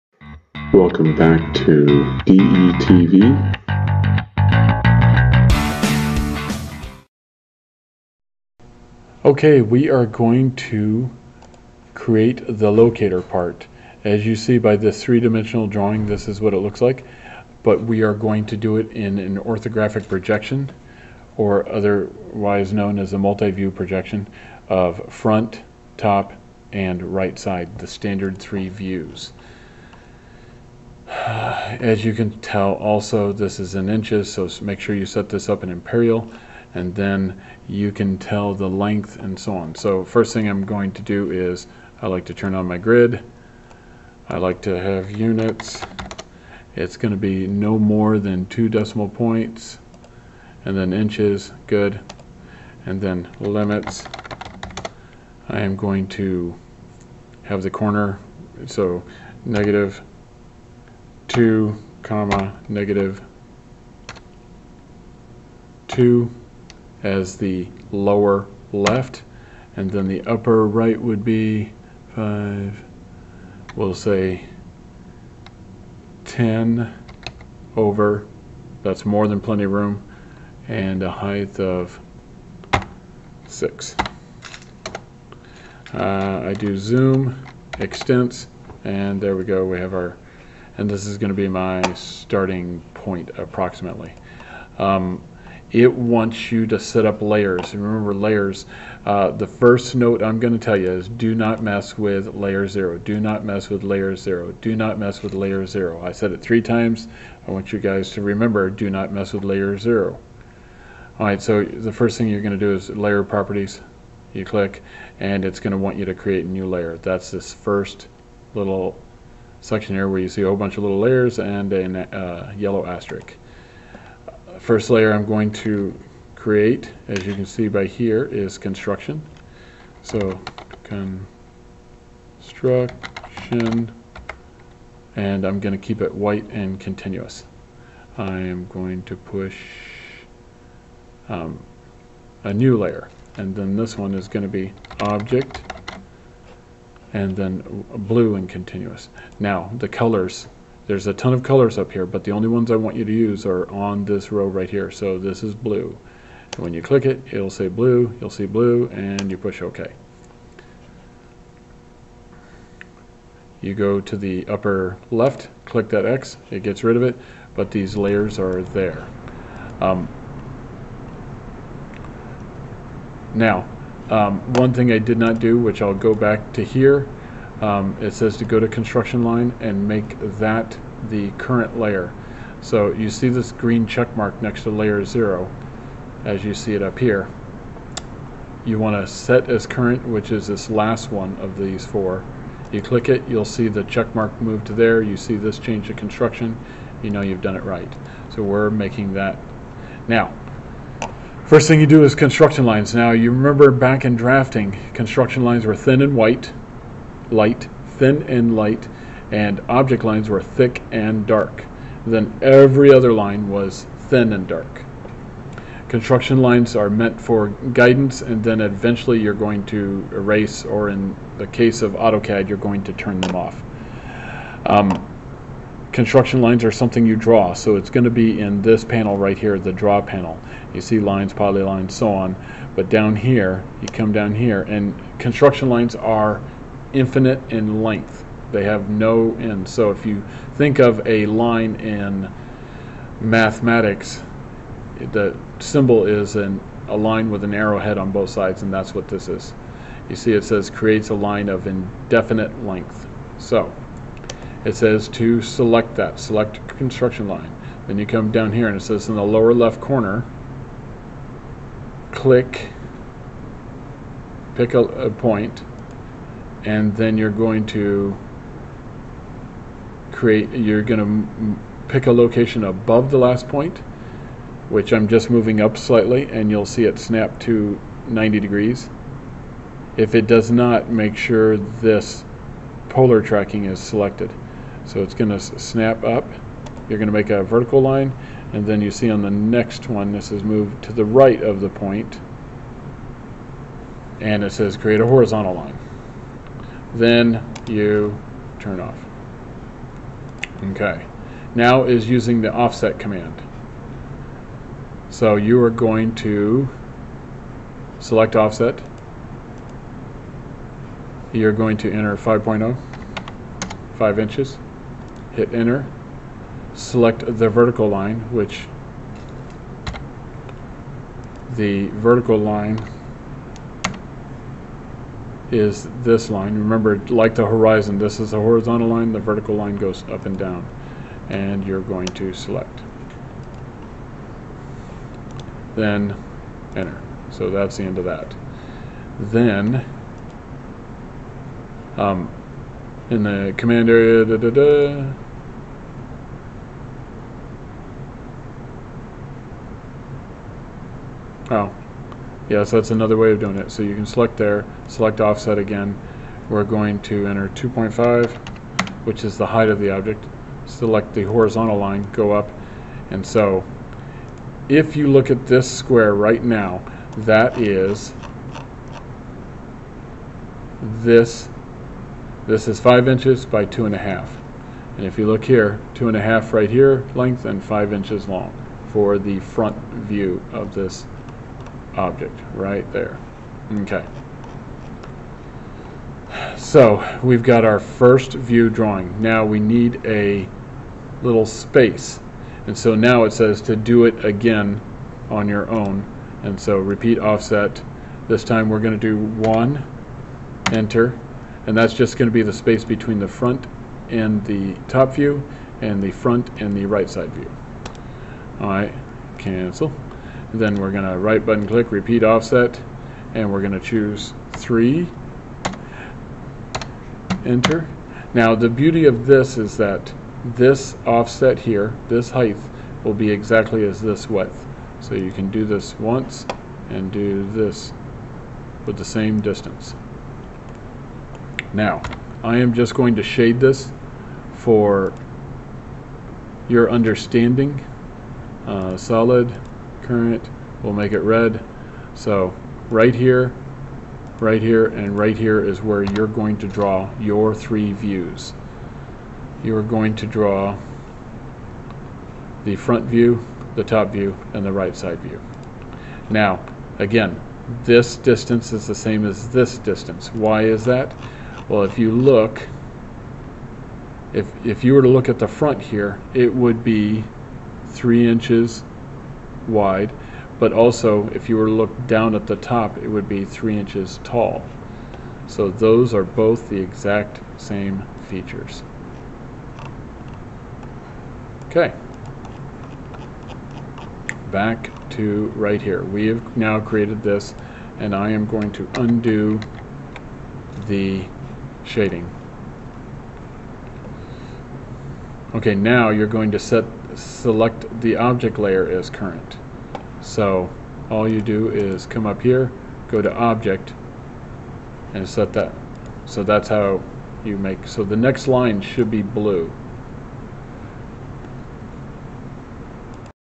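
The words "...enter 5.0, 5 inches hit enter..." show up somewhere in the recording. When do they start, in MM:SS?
05:11.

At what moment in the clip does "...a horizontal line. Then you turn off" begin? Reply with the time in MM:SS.
04:54.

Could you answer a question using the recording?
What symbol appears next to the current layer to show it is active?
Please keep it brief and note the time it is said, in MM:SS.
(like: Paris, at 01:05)
green check mark, at 03:03.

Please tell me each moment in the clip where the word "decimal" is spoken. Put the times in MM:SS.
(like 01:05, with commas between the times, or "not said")
00:48.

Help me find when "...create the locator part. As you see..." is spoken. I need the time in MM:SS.
00:11.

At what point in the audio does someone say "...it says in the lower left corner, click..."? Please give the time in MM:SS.
04:18.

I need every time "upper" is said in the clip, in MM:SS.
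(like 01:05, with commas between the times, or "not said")
01:10, 02:44.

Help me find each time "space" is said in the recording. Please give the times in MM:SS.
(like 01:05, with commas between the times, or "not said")
06:31, 06:42.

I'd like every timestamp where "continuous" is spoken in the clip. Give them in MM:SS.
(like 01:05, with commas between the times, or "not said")
02:16, 02:28.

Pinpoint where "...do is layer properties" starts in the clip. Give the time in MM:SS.
01:52.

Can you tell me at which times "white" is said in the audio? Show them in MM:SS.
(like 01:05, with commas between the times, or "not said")
02:16, 03:26.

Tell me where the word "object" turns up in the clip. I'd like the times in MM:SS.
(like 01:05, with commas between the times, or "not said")
02:25, 03:29, 05:59, 06:21, 08:18, 08:23.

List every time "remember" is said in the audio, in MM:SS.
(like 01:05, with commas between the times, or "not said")
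01:37, 01:48, 03:23, 05:26.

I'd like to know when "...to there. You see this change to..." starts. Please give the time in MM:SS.
03:14.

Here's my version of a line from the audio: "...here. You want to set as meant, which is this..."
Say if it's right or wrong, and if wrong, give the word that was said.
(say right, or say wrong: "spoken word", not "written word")
wrong: "current", not "meant".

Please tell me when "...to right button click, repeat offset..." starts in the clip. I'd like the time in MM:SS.
06:51.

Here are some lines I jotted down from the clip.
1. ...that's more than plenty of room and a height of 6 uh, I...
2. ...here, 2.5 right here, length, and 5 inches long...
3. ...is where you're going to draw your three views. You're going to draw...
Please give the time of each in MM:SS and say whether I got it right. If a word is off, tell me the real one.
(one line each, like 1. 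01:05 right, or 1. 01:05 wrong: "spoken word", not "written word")
1. 01:18 right
2. 06:15 right
3. 07:25 right.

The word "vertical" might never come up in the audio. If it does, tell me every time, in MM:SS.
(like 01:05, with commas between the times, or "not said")
04:47, 05:17, 05:21, 05:29.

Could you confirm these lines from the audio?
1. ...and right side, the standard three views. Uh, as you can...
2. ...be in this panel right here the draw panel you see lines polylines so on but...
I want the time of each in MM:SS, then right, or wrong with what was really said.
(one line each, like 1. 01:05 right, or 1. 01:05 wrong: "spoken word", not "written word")
1. 00:26 right
2. 03:48 right.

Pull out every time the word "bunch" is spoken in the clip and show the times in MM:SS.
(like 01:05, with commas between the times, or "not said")
02:00.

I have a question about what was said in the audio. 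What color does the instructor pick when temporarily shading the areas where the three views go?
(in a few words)
red.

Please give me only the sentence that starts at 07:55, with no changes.
So those are both the exact same features.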